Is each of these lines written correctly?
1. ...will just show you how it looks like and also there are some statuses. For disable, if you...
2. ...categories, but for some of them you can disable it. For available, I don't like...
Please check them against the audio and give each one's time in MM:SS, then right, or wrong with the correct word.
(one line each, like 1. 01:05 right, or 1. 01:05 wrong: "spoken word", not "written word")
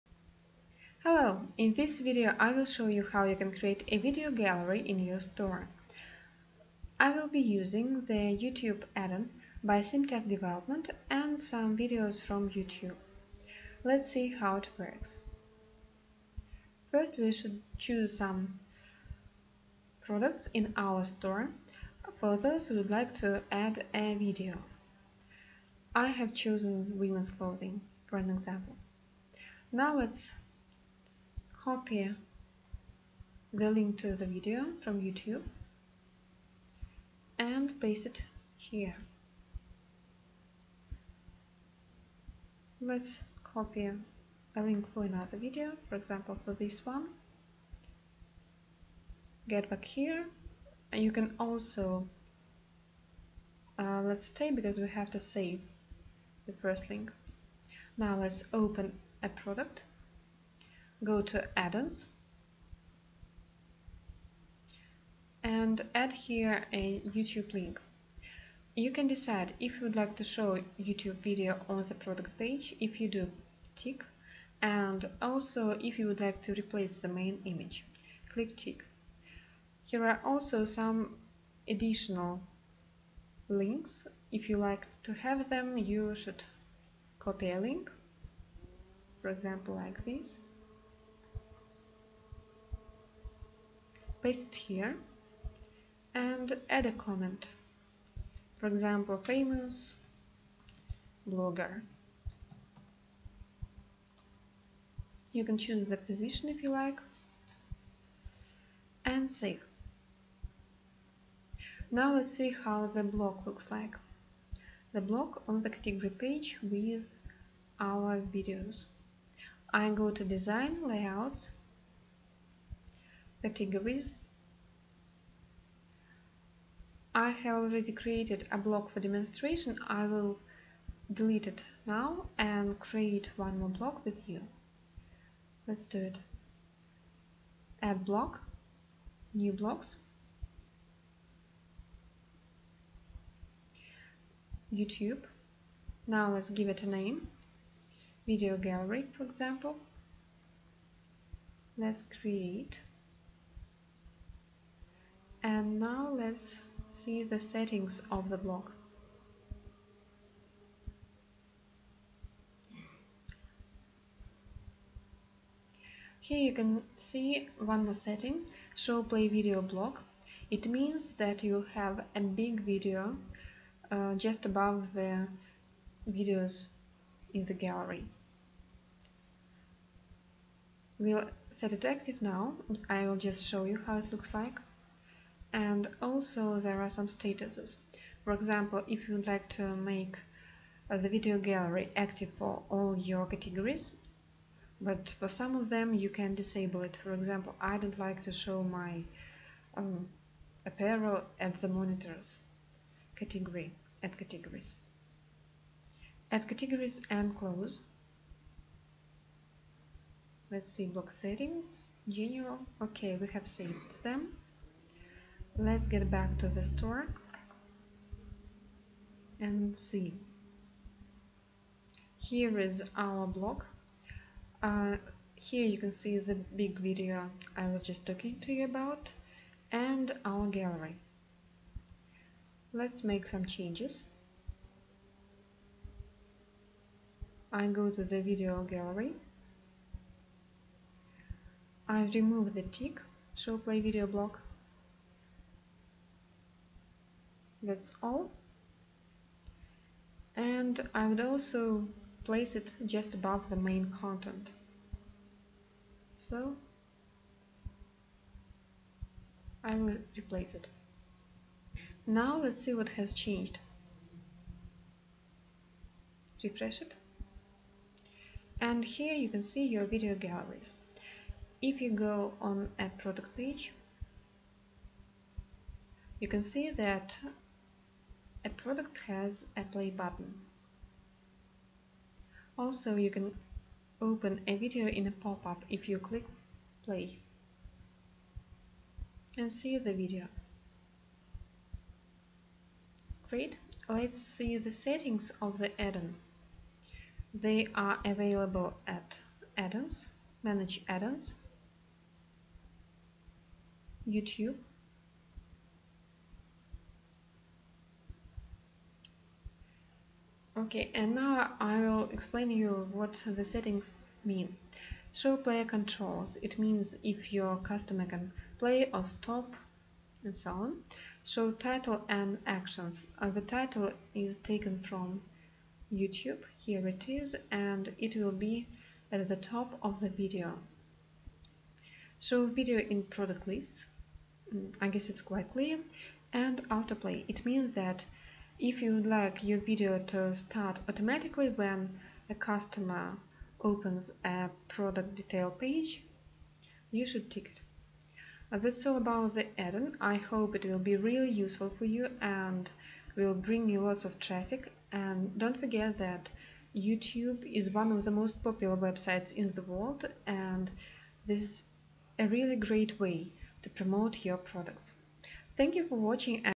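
1. 03:03 wrong: "example", not "disable"
2. 03:13 wrong: "example", not "available".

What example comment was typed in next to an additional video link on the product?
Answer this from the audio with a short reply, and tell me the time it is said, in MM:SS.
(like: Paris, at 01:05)
Famous blogger, at 01:39.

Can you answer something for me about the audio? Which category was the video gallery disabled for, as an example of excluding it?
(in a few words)
Monitors.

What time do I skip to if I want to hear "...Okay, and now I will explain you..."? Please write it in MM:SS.
05:10.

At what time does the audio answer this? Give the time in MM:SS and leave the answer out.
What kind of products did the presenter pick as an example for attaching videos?
00:26.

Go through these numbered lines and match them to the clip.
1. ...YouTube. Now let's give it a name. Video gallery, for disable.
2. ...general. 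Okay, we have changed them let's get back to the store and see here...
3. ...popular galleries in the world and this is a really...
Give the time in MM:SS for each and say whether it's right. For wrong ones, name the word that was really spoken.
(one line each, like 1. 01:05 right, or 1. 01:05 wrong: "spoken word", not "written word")
1. 02:24 wrong: "example", not "disable"
2. 03:32 wrong: "saved", not "changed"
3. 05:58 wrong: "websites", not "galleries".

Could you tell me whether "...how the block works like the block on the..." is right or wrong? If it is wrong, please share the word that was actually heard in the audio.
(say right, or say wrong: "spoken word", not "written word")
wrong: "looks", not "works".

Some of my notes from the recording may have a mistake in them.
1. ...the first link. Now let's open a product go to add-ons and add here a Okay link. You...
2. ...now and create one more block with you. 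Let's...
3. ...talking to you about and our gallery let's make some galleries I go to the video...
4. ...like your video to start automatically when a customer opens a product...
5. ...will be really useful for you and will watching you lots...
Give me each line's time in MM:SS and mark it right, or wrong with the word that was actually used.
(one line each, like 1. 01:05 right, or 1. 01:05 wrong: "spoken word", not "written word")
1. 00:56 wrong: "YouTube", not "Okay"
2. 02:11 right
3. 03:48 wrong: "changes", not "galleries"
4. 05:39 right
5. 05:50 wrong: "bring", not "watching".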